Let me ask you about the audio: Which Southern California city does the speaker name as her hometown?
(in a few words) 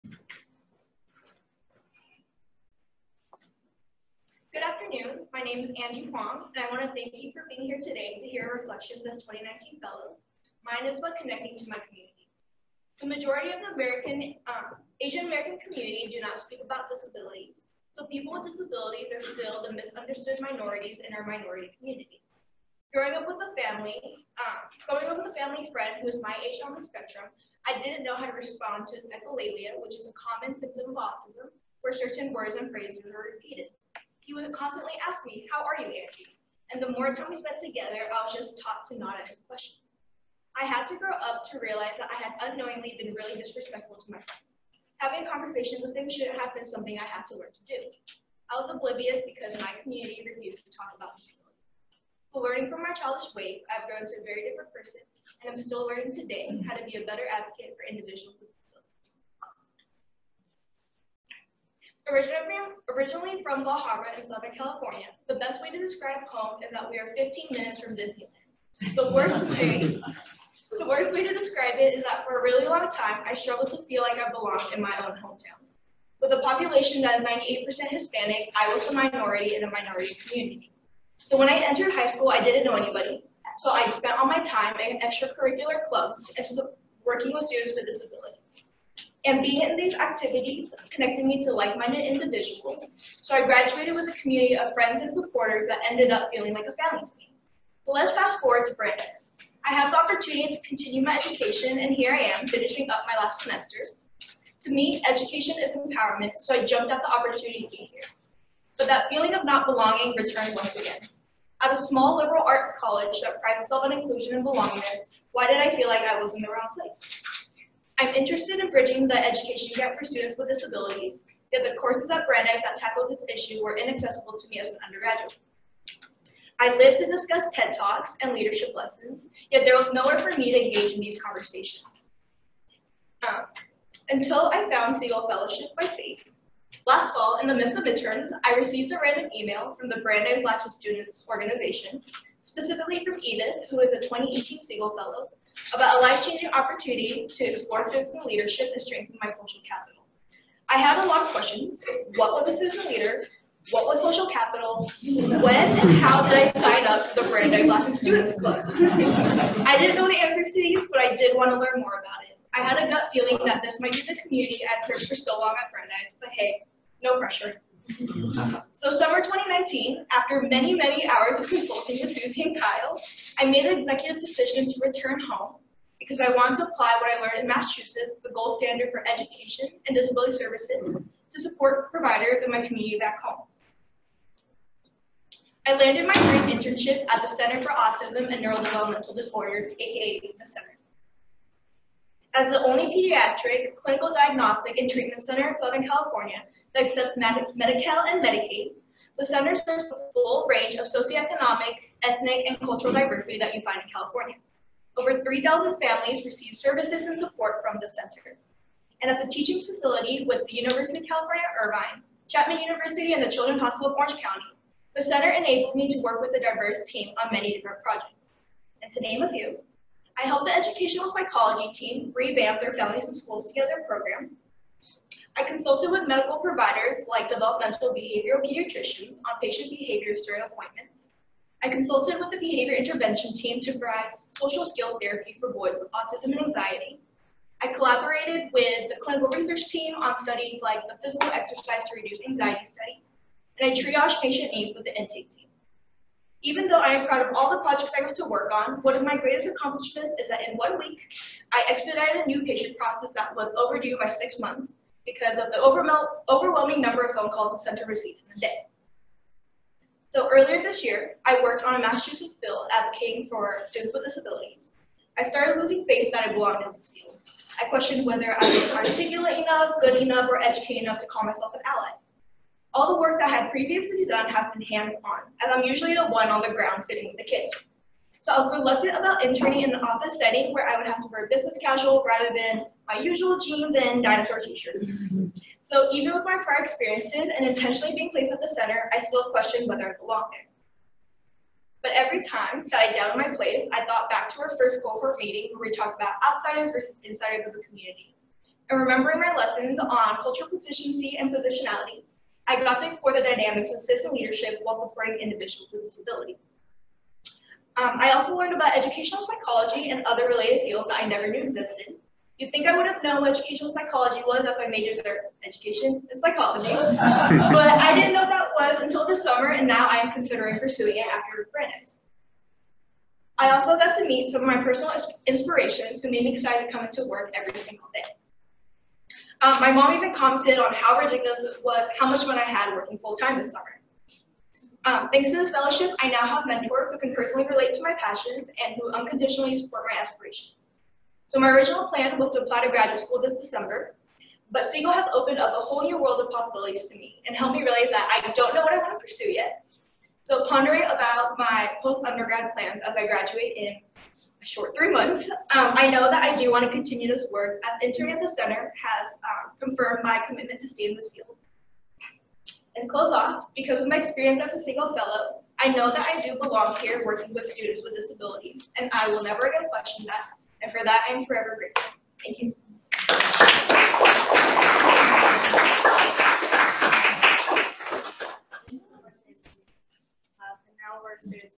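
La Habra.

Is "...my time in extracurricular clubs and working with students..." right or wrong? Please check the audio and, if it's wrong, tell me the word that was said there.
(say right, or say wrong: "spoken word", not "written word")
right.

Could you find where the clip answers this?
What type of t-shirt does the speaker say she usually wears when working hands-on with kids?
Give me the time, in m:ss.
4:44.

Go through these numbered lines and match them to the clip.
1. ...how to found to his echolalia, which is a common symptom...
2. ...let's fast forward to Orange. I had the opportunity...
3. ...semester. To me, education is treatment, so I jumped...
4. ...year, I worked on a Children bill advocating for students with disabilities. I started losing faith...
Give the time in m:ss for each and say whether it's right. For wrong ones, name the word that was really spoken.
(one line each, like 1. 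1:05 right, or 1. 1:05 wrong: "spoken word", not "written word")
1. 0:28 wrong: "respond", not "found"
2. 1:37 wrong: "Brandeis", not "Orange"
3. 1:43 wrong: "empowerment", not "treatment"
4. 4:20 wrong: "Massachusetts", not "Children".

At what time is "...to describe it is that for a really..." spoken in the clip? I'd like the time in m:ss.
1:11.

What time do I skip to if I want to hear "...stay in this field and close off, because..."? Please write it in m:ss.
6:00.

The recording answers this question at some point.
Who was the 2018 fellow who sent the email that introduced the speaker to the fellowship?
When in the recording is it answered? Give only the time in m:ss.
2:23.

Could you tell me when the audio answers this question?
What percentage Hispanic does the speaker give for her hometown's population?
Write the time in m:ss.
1:17.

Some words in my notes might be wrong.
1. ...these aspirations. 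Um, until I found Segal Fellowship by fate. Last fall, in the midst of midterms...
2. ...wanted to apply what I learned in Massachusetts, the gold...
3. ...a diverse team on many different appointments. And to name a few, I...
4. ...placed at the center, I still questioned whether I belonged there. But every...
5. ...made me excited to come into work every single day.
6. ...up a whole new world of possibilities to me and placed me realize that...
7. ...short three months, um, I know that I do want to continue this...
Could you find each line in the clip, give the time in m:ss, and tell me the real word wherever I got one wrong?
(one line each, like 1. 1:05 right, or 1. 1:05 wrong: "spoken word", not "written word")
1. 2:10 wrong: "conversations", not "aspirations"
2. 2:56 right
3. 3:36 wrong: "projects", not "appointments"
4. 4:48 right
5. 5:26 right
6. 5:45 wrong: "helped", not "placed"
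7. 5:54 right.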